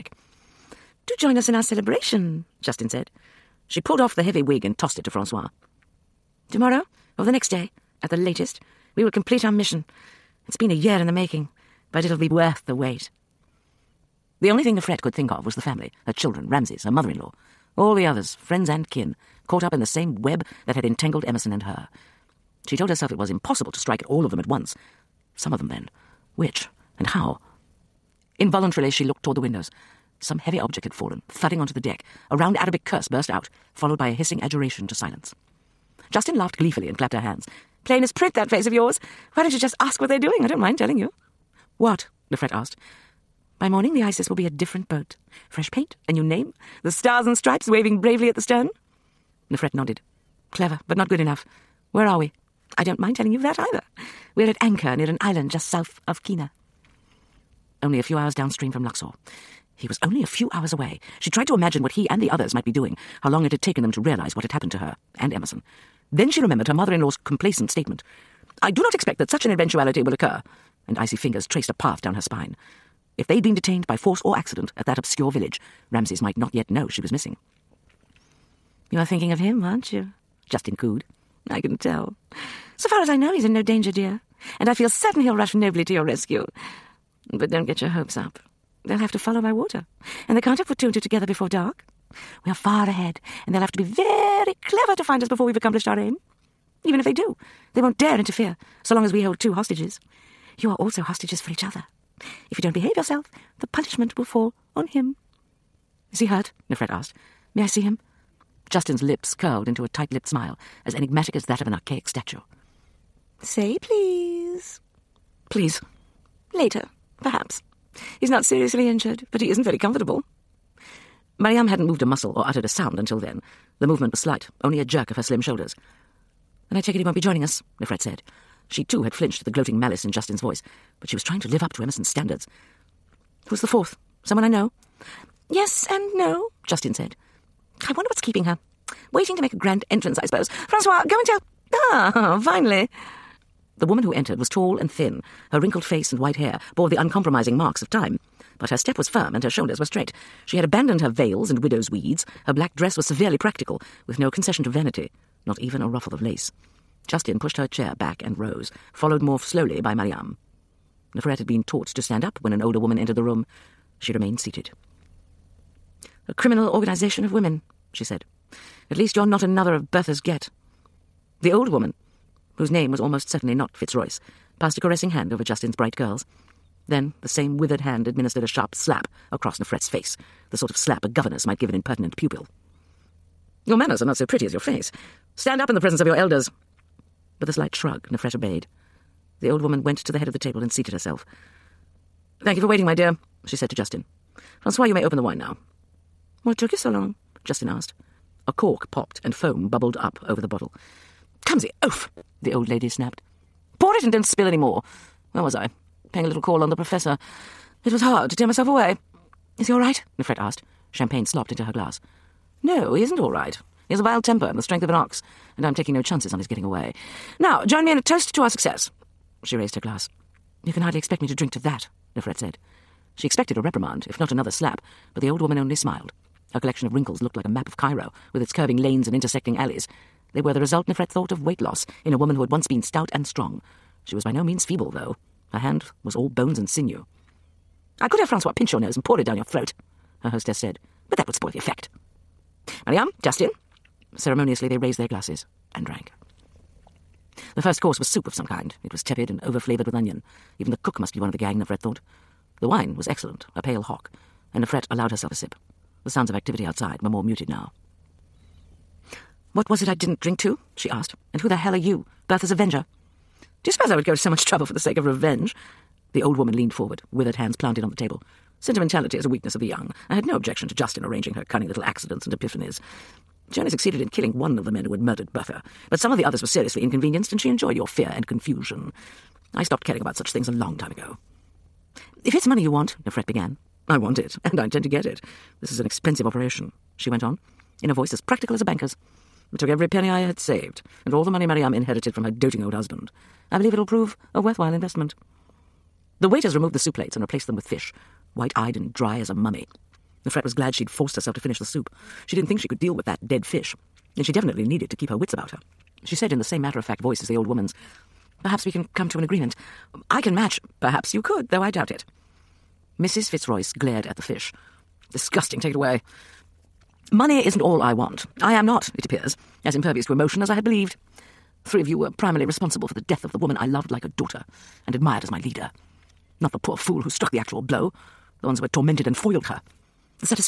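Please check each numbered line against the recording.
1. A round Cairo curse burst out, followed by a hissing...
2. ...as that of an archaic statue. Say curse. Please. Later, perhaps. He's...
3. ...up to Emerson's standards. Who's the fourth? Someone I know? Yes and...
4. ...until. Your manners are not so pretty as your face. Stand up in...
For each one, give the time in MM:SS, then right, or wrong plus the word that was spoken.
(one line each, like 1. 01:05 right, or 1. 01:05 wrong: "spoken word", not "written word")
1. 00:32 wrong: "Arabic", not "Cairo"
2. 01:51 wrong: "please", not "curse"
3. 02:11 right
4. 03:02 wrong: "pupil", not "until".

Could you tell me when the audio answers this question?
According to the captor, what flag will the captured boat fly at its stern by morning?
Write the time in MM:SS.
00:46.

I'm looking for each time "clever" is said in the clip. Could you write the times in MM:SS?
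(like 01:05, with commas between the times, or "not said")
00:50, 01:34.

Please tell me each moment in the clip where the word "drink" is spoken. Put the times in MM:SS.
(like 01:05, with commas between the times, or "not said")
03:41, 04:20.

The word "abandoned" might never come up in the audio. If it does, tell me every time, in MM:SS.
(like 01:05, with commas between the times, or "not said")
02:30.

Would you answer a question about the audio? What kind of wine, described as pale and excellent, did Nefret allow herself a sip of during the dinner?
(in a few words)
hock.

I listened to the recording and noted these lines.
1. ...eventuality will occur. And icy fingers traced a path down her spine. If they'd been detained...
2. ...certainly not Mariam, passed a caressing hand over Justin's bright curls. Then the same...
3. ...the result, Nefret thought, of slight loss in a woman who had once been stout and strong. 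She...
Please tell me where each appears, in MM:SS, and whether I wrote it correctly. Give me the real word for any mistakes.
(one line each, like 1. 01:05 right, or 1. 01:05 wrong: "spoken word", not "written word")
1. 01:09 right
2. 02:53 wrong: "Fitzroyce", not "Mariam"
3. 03:50 wrong: "weight", not "slight".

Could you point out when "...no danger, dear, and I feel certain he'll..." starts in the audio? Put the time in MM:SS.
01:23.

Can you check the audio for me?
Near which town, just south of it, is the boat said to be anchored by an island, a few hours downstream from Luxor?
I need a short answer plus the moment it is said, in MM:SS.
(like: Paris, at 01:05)
Qena, at 00:56.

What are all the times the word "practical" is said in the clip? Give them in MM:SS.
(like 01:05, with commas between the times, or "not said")
02:33, 04:48.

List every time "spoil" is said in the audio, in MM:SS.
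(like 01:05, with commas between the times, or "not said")
04:01.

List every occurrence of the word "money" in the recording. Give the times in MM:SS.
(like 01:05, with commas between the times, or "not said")
04:42, 04:51, 05:17.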